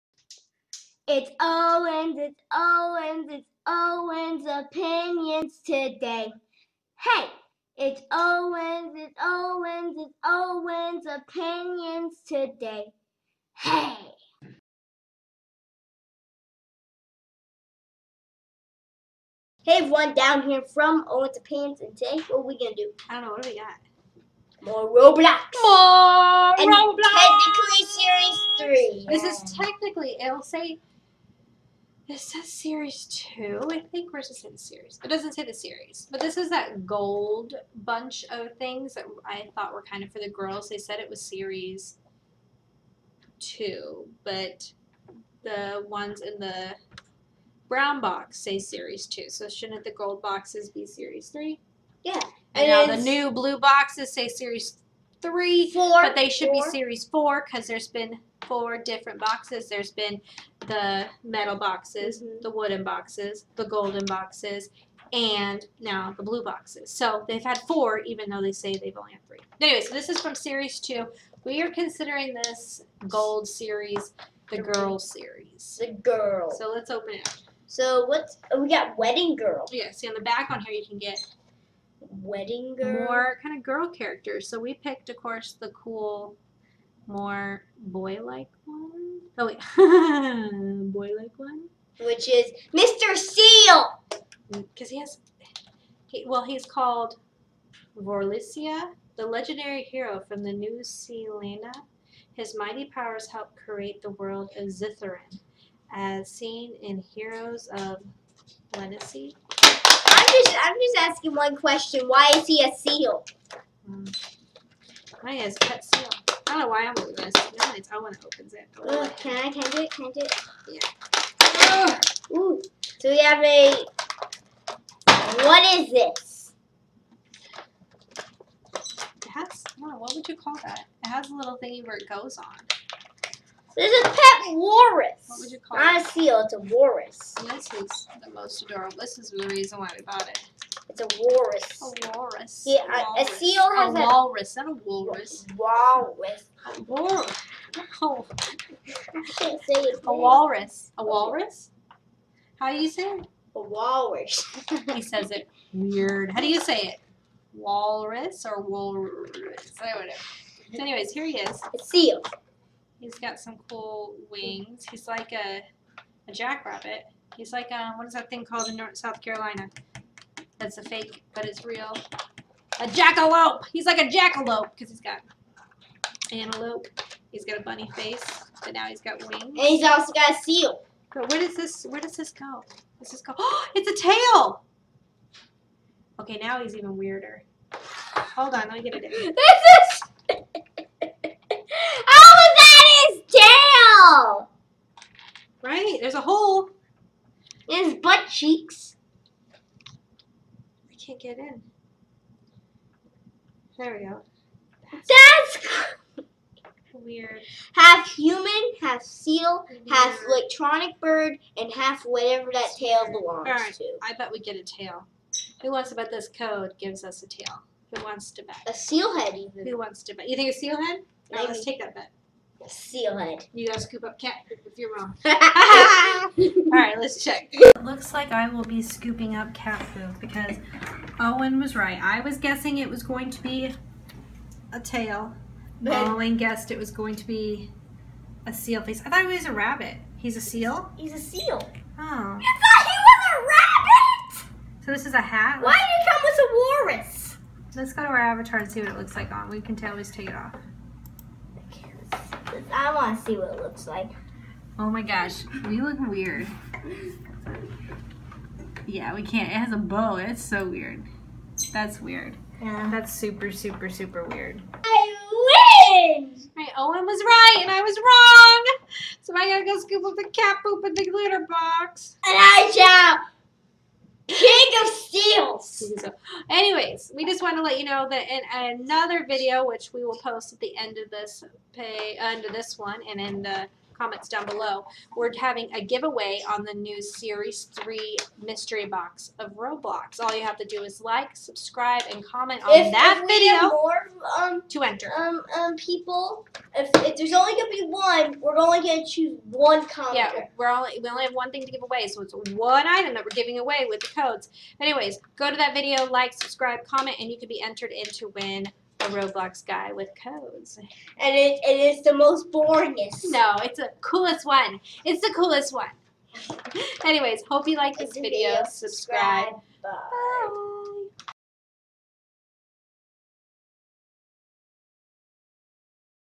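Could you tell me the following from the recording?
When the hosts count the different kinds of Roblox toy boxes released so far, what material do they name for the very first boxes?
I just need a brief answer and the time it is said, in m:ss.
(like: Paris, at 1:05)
metal, at 1:01.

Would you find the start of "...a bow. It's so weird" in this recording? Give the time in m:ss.
4:19.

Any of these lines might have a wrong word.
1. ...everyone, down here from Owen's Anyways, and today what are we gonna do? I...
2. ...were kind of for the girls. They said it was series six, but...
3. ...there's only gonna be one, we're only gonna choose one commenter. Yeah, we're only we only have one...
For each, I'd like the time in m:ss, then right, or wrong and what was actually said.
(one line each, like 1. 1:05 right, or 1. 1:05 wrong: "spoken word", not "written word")
1. 0:19 wrong: "Opinions", not "Anyways"
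2. 0:39 wrong: "two", not "six"
3. 4:57 right.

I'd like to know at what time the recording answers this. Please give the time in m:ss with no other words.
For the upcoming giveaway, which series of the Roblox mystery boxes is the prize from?
4:47.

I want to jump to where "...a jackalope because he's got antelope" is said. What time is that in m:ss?
2:53.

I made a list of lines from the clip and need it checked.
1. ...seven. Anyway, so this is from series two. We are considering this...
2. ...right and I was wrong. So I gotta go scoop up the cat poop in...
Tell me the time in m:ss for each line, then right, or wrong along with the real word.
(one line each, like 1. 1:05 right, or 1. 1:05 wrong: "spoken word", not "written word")
1. 1:09 wrong: "three", not "seven"
2. 4:27 right.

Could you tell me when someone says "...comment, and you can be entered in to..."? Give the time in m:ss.
5:06.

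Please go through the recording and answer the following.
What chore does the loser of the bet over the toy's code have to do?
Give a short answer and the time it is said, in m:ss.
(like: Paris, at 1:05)
scoop up cat poop, at 3:43.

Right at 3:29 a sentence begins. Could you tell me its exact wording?
half electronic bird, and half whatever that tail belongs All right.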